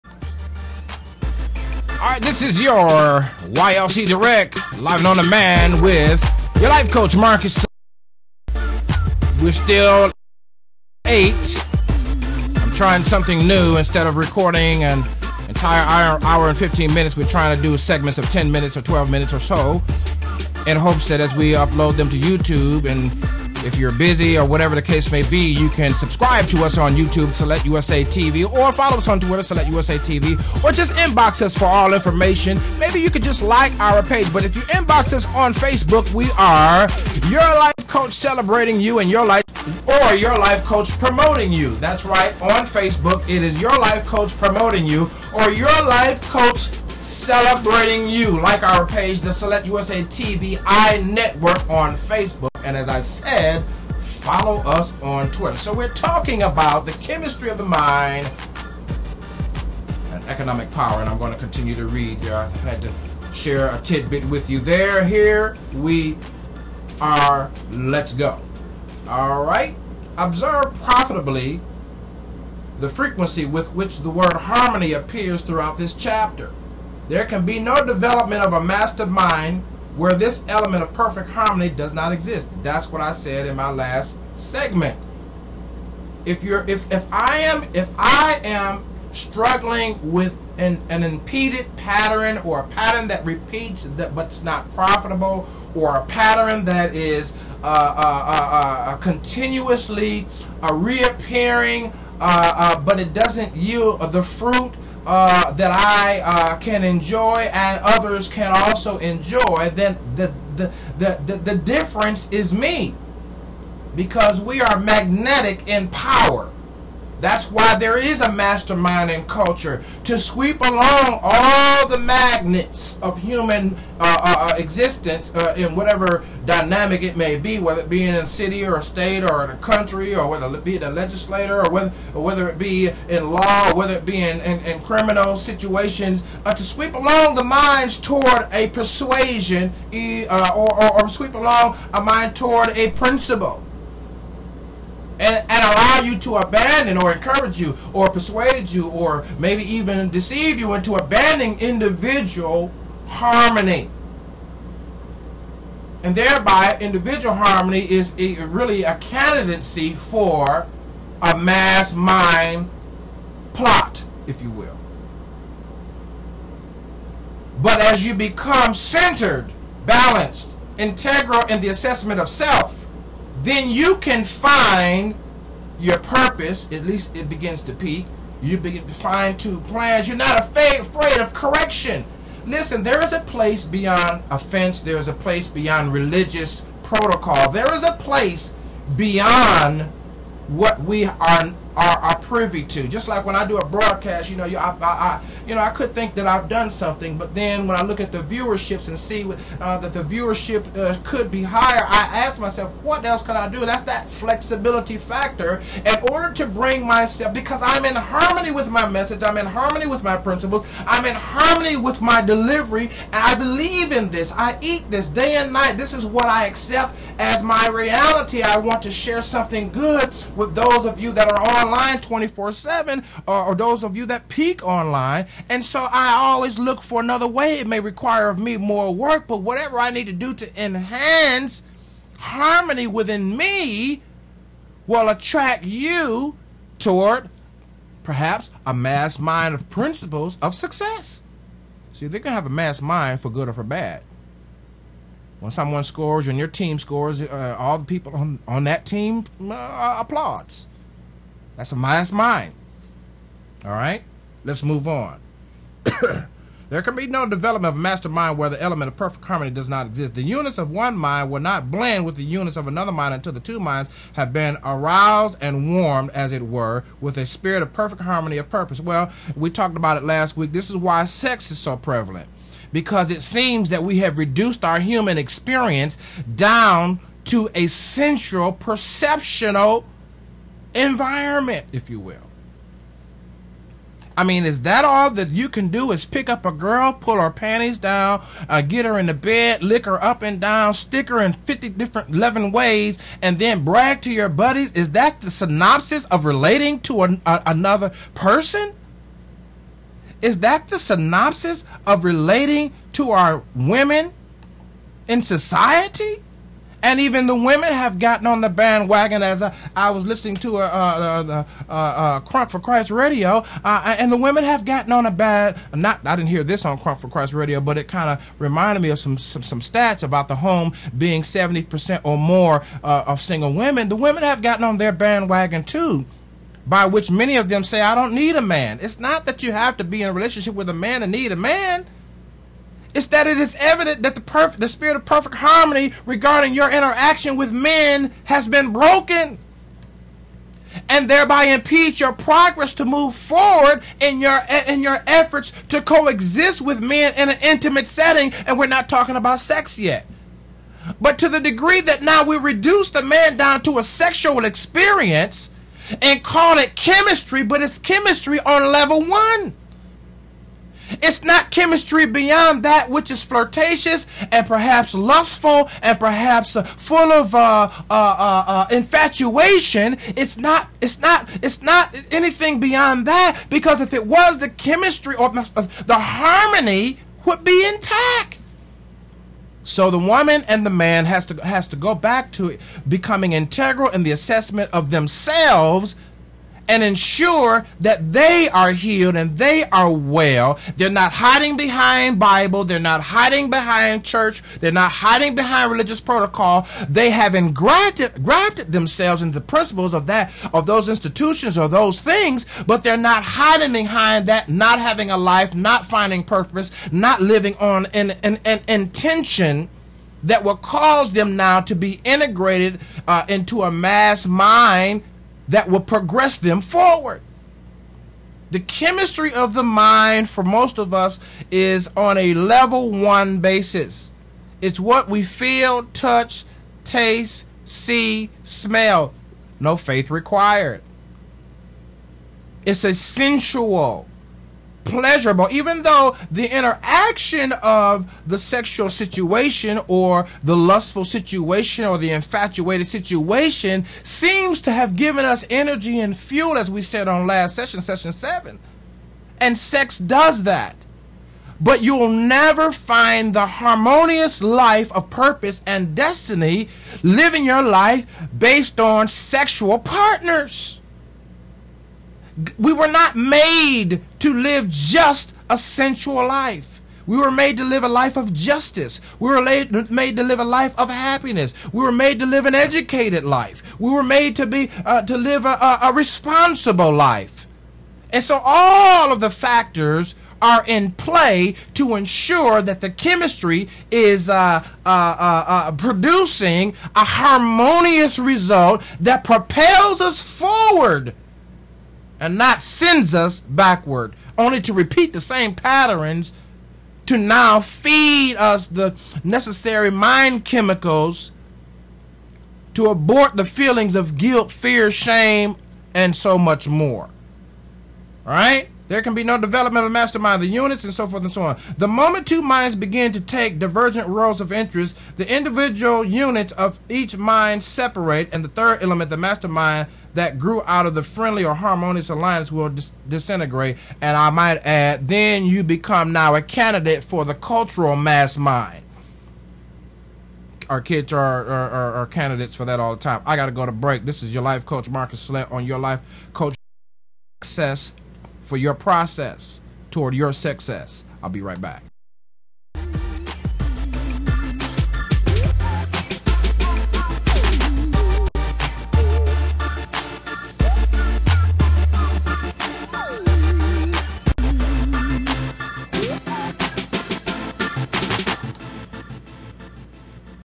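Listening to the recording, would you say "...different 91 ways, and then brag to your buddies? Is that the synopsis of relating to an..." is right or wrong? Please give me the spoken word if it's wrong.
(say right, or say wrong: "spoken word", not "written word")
wrong: "11", not "91".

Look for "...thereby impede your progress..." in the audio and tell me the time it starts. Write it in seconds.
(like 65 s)
341 s.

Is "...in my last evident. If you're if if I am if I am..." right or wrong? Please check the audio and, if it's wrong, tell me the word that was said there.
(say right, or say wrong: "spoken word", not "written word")
wrong: "segment", not "evident".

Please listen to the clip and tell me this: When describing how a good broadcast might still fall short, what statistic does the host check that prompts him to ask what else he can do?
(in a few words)
viewership.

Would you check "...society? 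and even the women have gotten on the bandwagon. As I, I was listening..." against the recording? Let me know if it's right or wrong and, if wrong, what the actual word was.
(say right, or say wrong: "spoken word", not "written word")
right.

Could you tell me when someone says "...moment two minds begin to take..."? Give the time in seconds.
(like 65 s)
511 s.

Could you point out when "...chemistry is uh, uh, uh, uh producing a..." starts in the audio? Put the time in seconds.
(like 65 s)
482 s.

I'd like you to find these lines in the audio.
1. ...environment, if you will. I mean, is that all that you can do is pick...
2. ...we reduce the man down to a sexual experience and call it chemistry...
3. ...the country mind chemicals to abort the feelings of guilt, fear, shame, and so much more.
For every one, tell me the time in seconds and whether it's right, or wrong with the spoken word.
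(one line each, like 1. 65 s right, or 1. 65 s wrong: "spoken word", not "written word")
1. 280 s right
2. 352 s right
3. 498 s wrong: "necessary", not "country".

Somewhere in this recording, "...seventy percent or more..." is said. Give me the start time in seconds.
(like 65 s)
321 s.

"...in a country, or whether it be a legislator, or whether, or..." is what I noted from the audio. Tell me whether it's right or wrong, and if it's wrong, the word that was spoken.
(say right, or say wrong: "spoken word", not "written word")
right.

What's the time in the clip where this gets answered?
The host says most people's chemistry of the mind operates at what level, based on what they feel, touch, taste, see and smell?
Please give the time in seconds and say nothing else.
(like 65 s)
422 s.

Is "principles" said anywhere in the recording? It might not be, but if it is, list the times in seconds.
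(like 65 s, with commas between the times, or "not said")
142 s, 210 s, 239 s, 399 s.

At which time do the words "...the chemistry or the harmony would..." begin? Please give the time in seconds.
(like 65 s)
374 s.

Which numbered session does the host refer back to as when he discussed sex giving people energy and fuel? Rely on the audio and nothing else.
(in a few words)
session 7.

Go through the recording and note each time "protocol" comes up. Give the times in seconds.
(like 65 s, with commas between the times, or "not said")
186 s, 395 s.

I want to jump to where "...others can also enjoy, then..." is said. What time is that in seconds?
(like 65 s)
107 s.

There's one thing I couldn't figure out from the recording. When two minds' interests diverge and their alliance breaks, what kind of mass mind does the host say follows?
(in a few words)
cultural mass mind.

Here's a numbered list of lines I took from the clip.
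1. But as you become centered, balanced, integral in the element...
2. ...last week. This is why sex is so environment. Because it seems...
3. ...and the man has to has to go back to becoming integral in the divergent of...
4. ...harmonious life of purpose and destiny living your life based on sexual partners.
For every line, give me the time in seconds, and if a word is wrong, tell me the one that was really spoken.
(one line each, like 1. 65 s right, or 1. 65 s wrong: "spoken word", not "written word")
1. 167 s wrong: "assessment", not "element"
2. 270 s wrong: "prevalent", not "environment"
3. 380 s wrong: "assessment", not "divergent"
4. 453 s right.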